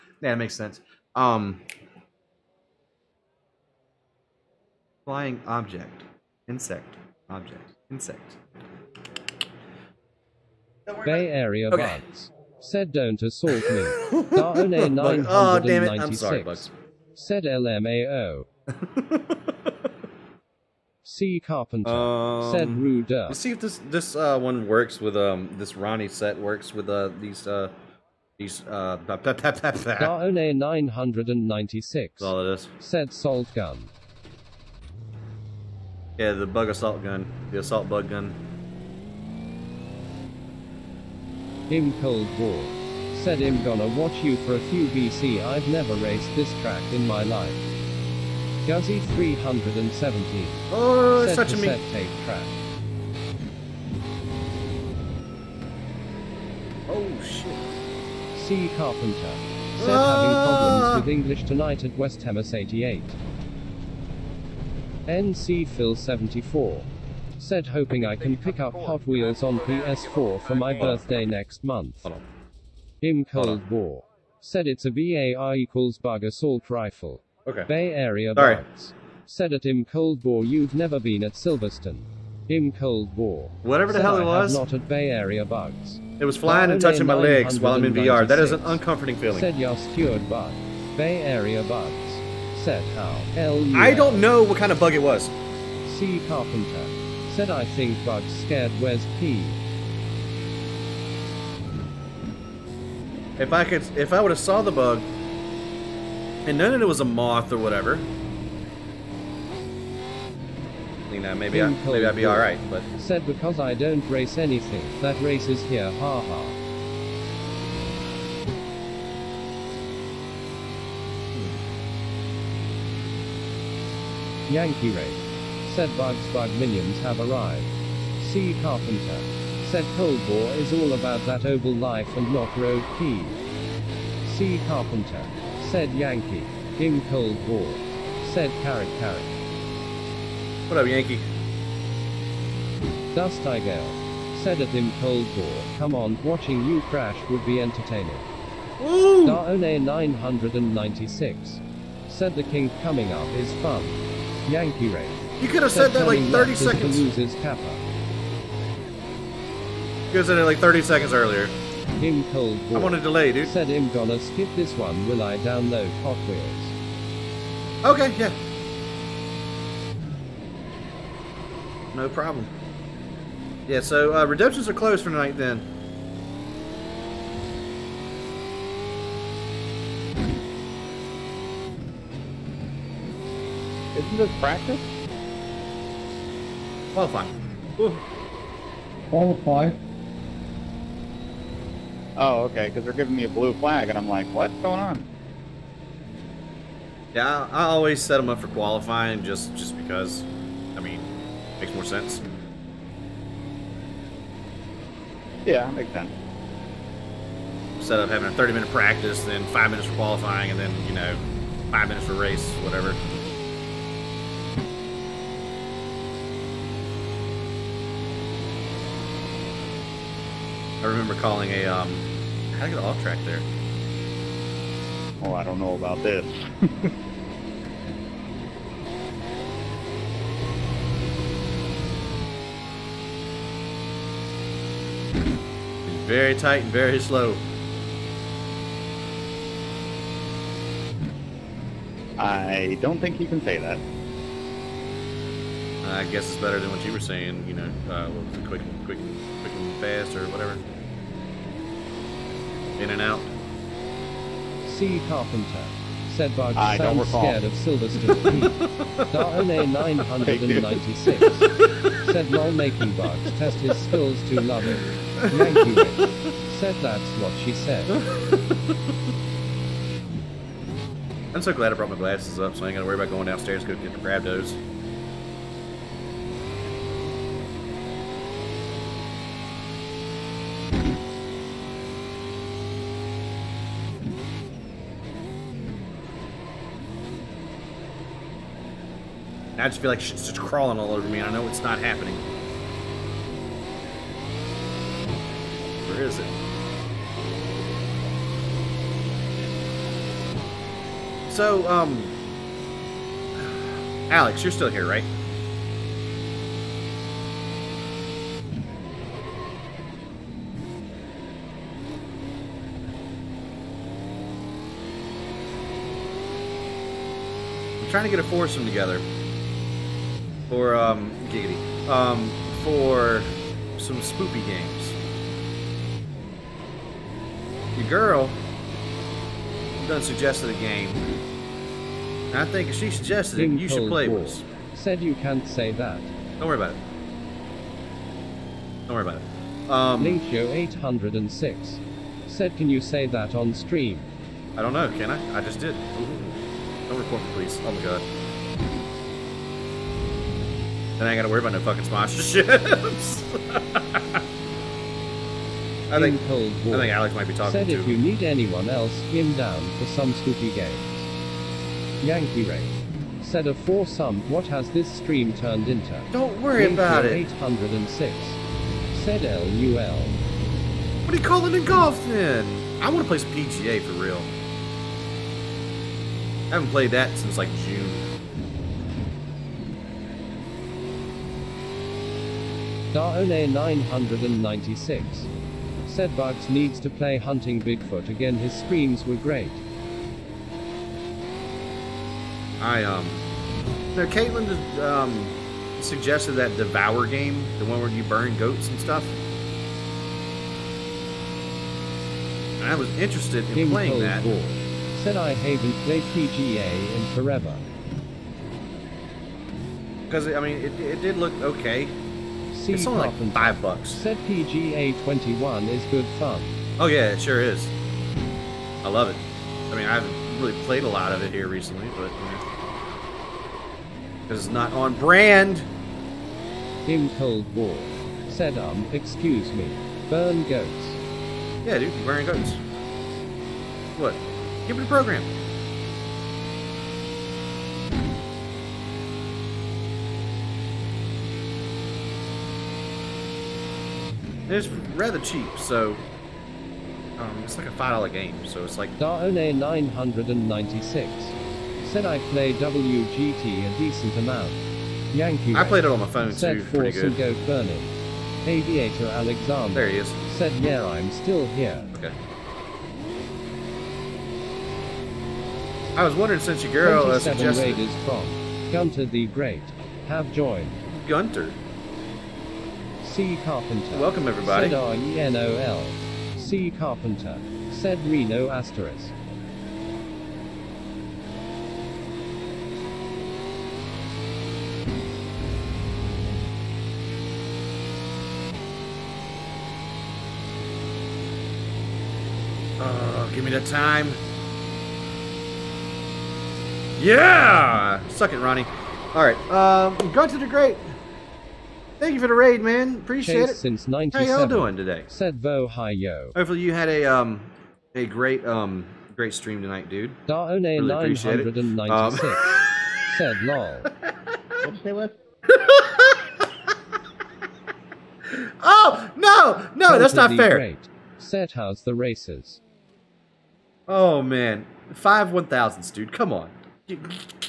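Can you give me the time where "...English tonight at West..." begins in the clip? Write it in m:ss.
1:01.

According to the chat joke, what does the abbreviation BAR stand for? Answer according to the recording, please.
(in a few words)
bug assault rifle.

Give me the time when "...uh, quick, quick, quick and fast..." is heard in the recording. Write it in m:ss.
4:07.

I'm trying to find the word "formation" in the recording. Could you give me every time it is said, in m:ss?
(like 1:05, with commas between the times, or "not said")
not said.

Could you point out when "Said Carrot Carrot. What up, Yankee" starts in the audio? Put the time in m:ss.
2:18.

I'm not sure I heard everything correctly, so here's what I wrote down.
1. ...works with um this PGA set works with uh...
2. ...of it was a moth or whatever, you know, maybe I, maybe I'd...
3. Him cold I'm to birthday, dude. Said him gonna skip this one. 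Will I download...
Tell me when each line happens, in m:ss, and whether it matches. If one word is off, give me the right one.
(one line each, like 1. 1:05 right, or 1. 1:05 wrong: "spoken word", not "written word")
1. 0:24 wrong: "Ronnie", not "PGA"
2. 1:46 right
3. 2:41 wrong: "delay", not "birthday".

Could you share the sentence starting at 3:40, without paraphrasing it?
remember calling a, um, how to get off track there?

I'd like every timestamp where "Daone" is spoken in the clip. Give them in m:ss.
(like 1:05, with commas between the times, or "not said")
2:29, 7:28, 8:30.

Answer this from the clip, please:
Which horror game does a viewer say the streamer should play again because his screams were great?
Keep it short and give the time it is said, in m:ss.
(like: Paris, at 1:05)
Hunting Bigfoot, at 6:27.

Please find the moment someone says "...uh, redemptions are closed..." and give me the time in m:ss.
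2:54.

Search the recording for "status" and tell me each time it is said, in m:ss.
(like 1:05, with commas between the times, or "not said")
not said.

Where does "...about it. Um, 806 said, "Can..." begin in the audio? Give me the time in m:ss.
5:39.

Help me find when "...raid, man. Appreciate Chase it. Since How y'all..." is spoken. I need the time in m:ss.
8:22.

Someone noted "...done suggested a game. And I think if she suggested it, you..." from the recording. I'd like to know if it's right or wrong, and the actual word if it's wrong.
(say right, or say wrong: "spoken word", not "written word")
right.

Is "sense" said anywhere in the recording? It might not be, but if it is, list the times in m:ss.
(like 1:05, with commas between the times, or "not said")
0:00, 3:21, 3:25.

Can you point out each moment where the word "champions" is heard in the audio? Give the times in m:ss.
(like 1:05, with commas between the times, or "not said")
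not said.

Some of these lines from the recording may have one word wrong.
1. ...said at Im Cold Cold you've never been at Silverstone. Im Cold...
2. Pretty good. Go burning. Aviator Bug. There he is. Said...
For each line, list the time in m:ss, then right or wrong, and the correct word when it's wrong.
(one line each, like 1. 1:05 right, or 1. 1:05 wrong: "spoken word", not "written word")
1. 1:19 wrong: "War", not "Cold"
2. 7:36 wrong: "Alexander", not "Bug".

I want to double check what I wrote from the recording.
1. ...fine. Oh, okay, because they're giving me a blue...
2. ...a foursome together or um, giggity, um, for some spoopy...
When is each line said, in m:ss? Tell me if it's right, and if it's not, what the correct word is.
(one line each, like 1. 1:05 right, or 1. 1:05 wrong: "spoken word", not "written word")
1. 3:09 right
2. 5:18 right.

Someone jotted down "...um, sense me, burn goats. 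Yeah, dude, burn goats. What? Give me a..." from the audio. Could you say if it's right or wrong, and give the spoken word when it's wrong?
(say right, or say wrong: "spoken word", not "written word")
wrong: "excuse", not "sense".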